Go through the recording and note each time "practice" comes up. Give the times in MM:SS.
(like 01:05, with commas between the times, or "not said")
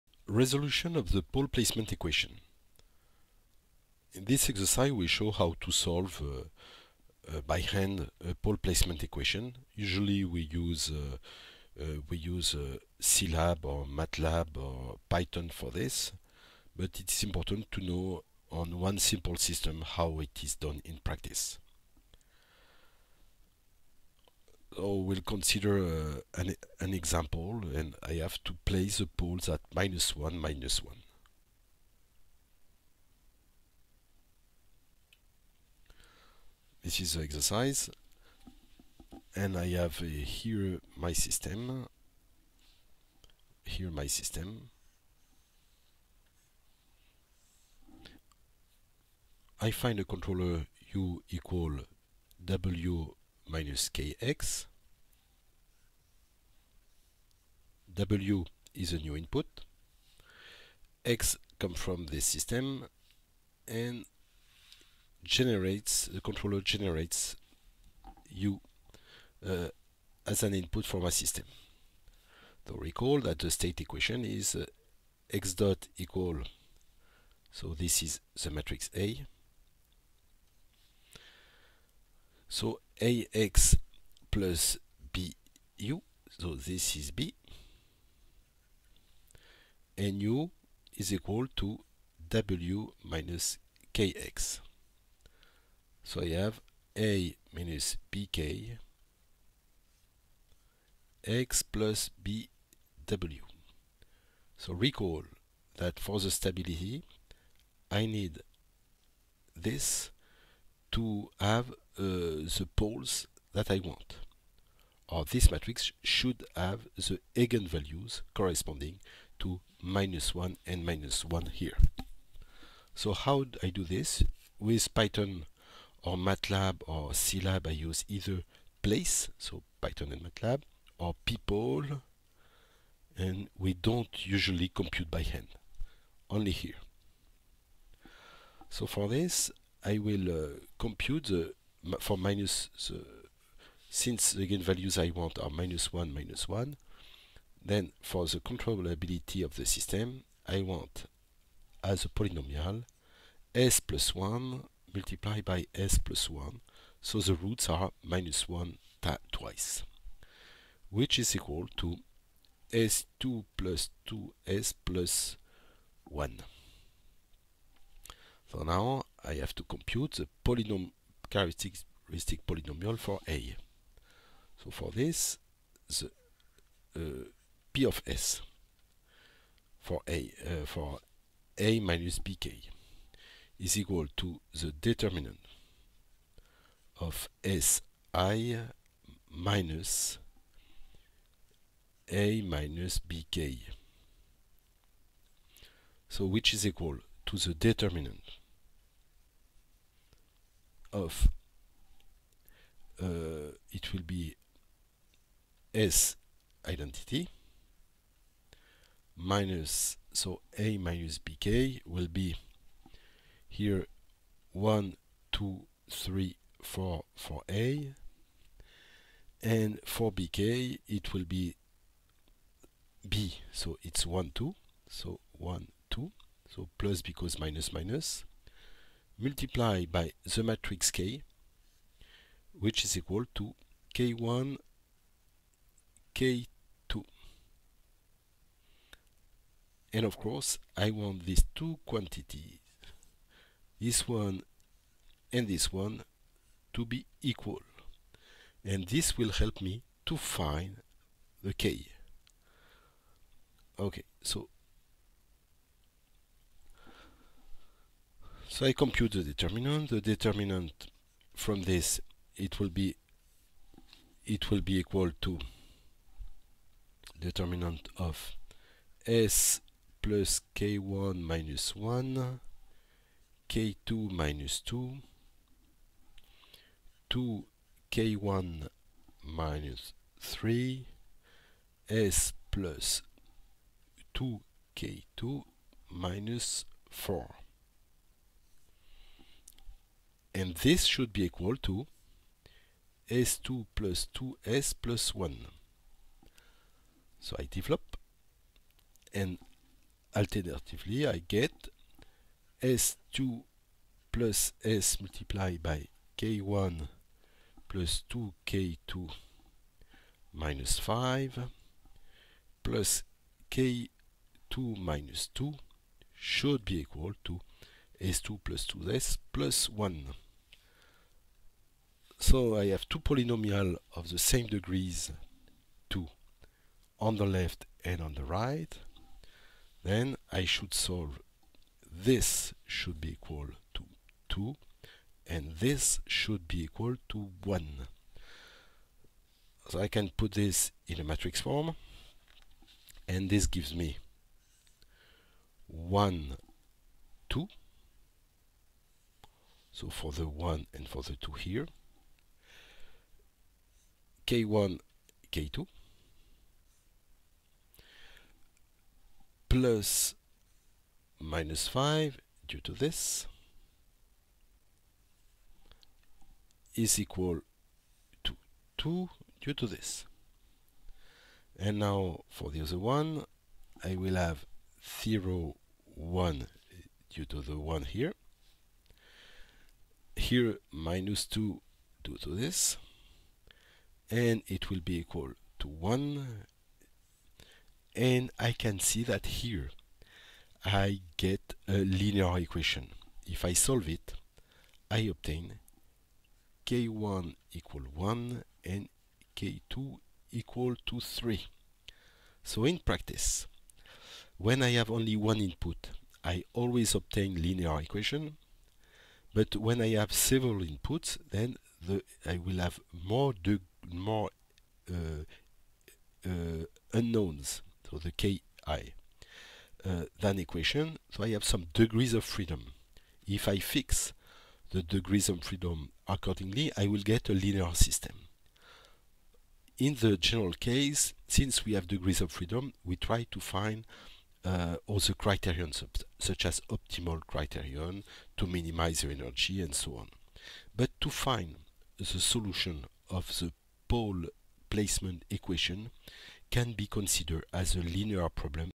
00:21, 06:42.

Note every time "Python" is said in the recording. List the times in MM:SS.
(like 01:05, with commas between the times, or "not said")
00:15, 02:04, 02:09.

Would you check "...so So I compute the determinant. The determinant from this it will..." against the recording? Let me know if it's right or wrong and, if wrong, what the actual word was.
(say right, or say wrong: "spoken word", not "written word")
right.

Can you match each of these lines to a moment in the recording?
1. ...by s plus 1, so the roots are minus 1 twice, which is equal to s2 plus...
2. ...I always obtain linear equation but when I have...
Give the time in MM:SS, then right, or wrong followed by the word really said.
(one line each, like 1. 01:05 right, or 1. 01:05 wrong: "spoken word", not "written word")
1. 02:35 right
2. 06:46 right.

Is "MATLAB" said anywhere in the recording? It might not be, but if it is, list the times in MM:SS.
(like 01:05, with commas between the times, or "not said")
00:13, 02:06, 02:10.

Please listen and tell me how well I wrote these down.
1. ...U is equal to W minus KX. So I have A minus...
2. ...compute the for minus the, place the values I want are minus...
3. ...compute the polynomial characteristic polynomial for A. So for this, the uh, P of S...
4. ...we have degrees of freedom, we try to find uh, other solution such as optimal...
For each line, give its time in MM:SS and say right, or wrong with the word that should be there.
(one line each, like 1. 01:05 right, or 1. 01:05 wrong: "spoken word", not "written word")
1. 01:30 right
2. 02:20 wrong: "since", not "place"
3. 02:49 right
4. 07:11 wrong: "criterion", not "solution".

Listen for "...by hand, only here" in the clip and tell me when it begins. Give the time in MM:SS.
02:15.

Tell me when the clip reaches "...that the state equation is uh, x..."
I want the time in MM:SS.
01:13.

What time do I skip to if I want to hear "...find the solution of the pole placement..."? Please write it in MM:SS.
07:21.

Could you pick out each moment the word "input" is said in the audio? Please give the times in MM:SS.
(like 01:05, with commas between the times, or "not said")
00:59, 01:10, 06:45, 06:50.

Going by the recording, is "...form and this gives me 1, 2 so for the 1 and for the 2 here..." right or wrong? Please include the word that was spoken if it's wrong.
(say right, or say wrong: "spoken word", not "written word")
right.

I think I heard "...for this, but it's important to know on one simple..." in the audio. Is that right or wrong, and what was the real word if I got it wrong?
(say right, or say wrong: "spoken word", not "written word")
right.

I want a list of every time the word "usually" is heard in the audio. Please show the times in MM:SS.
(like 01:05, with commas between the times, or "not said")
00:09, 02:14.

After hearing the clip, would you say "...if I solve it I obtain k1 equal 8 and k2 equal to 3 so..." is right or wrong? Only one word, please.
wrong.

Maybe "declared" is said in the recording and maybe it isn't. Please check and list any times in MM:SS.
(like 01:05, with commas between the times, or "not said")
not said.